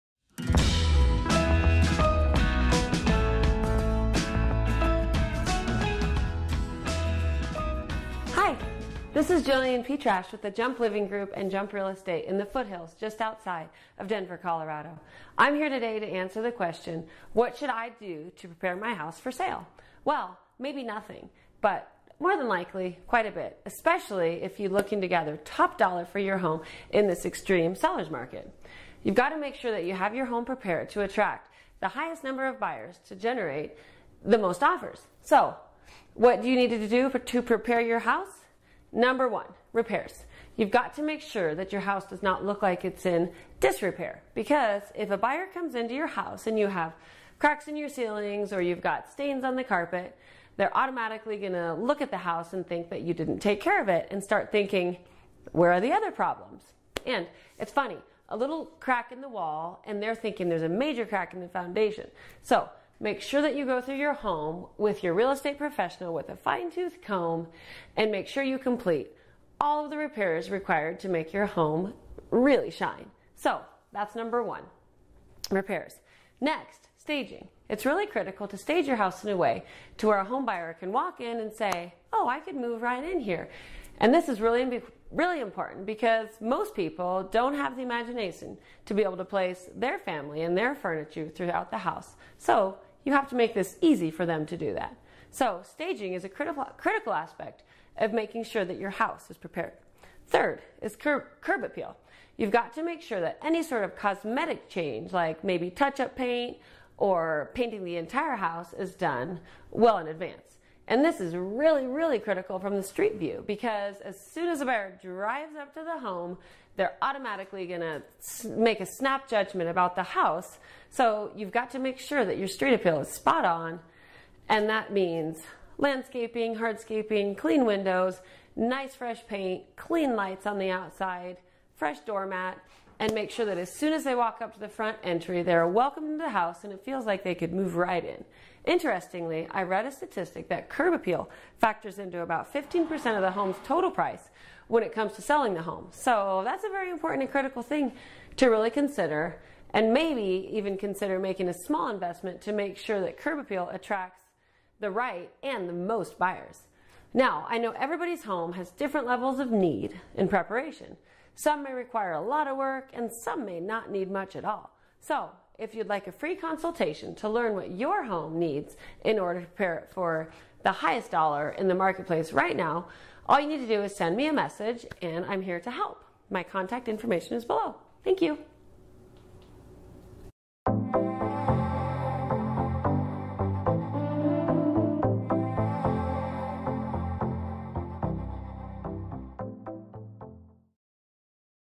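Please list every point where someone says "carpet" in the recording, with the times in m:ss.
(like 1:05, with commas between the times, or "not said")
0:49.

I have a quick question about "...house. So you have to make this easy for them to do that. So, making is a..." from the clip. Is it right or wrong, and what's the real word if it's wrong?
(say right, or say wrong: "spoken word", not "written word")
wrong: "staging", not "making".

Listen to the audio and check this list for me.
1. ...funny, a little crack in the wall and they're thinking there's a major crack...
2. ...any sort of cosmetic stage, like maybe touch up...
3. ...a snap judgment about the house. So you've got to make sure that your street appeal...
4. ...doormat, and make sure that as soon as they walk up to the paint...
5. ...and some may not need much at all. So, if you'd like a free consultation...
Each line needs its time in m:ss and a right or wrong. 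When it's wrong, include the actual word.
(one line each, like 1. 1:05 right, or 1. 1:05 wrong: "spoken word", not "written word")
1. 0:57 right
2. 1:43 wrong: "change", not "stage"
3. 1:58 right
4. 2:12 wrong: "front", not "paint"
5. 2:42 right.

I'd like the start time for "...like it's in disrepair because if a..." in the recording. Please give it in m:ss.
0:42.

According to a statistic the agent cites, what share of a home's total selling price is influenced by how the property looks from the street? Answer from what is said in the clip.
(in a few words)
15%.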